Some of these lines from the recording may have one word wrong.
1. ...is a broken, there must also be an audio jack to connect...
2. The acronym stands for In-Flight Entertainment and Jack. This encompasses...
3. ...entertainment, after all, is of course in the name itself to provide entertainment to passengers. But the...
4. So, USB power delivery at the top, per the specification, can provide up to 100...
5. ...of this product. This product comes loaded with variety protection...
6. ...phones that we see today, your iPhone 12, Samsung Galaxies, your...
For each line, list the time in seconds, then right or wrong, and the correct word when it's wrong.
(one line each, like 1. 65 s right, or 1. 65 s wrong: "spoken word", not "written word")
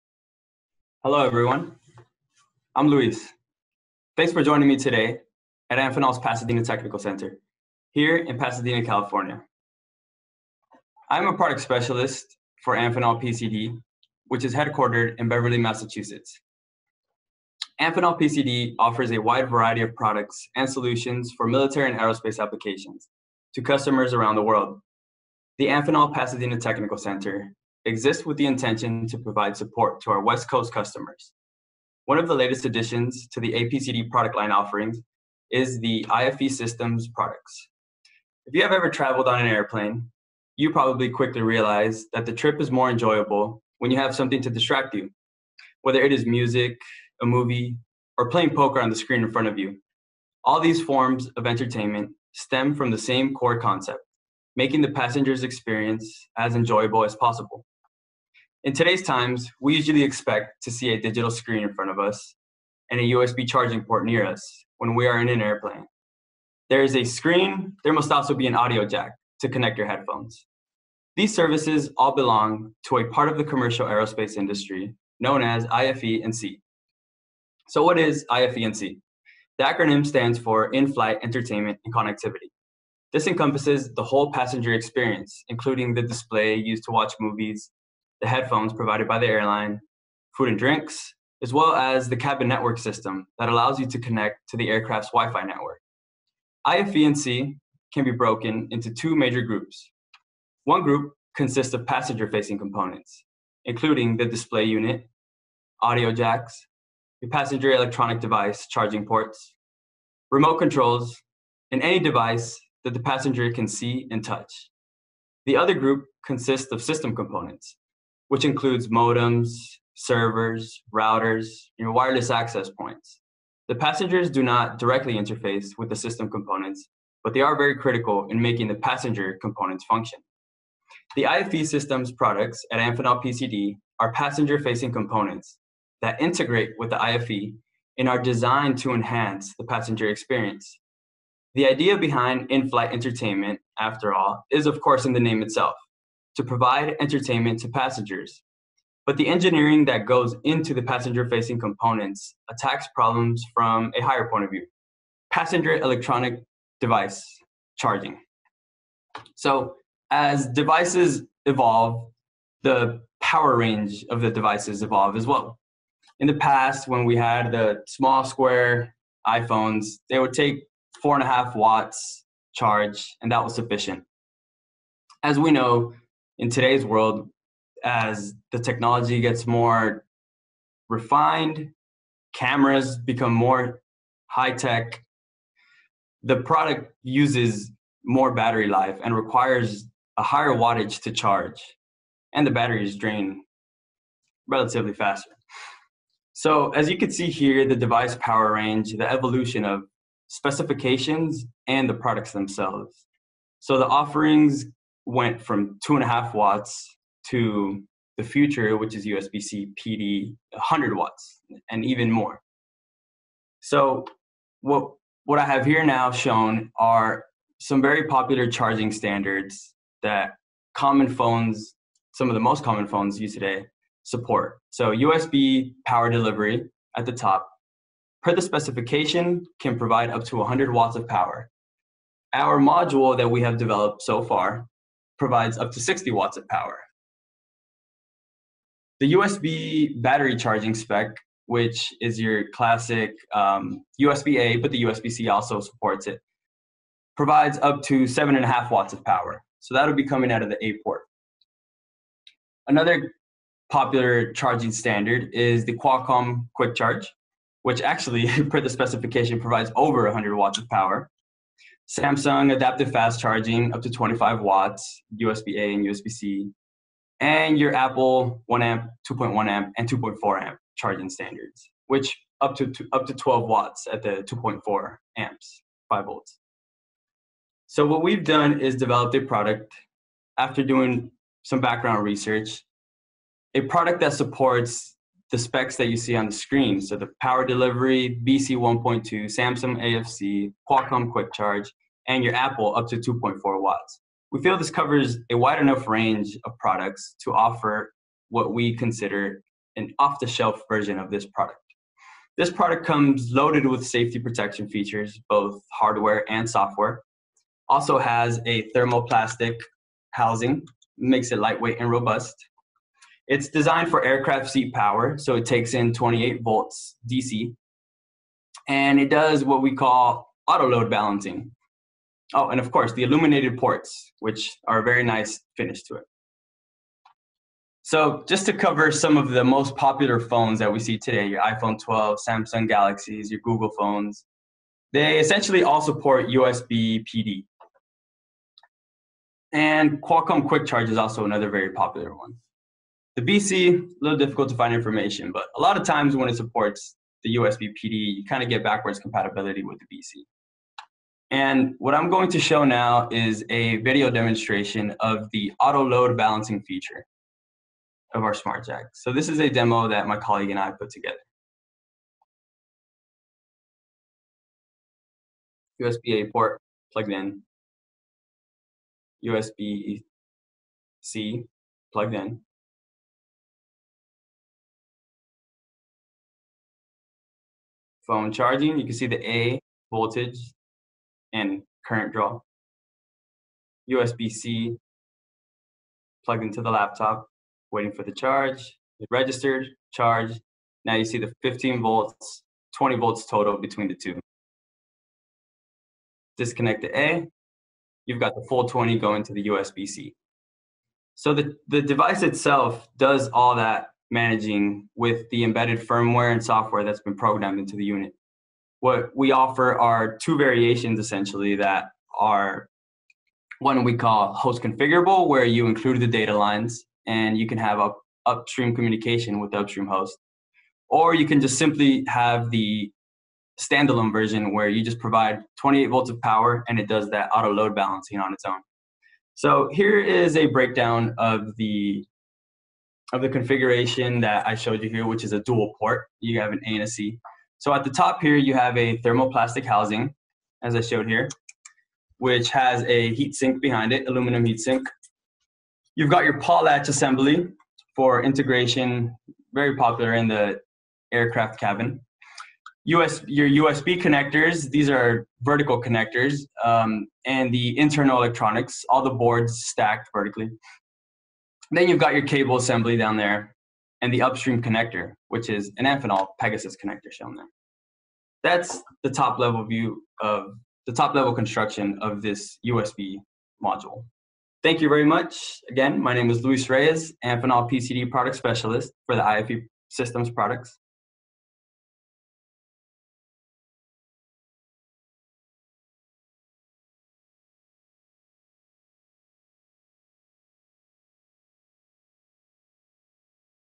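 1. 66 s wrong: "screen", not "broken"
2. 79 s wrong: "Connectivity", not "Jack"
3. 142 s right
4. 224 s right
5. 300 s wrong: "safety", not "variety"
6. 330 s right.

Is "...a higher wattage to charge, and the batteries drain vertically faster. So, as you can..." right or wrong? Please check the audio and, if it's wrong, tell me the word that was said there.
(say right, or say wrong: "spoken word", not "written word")
wrong: "relatively", not "vertically".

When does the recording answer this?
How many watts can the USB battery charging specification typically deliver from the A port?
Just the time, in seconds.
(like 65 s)
248 s.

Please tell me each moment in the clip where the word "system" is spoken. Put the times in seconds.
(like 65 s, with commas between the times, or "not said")
36 s, 92 s, 116 s, 125 s, 131 s, 479 s.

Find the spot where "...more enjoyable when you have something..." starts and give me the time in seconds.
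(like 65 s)
42 s.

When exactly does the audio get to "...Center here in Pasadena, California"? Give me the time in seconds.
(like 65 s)
6 s.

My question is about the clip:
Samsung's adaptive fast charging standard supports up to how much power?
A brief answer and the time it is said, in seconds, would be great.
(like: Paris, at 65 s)
25 watts, at 263 s.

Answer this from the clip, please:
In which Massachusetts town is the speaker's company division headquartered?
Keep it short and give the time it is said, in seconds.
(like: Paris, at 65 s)
Beverly, at 15 s.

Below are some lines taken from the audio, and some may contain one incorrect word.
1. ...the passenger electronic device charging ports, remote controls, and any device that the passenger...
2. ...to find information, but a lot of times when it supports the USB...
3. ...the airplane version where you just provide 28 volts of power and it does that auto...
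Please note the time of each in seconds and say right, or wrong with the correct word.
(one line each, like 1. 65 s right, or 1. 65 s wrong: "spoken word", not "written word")
1. 107 s right
2. 344 s right
3. 422 s wrong: "standalone", not "airplane".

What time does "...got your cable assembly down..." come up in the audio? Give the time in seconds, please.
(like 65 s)
461 s.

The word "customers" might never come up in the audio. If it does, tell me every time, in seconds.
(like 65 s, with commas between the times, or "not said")
23 s, 30 s.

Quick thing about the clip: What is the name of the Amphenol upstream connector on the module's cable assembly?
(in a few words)
Pegasus.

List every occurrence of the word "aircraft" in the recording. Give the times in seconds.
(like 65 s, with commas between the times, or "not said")
94 s, 314 s, 451 s.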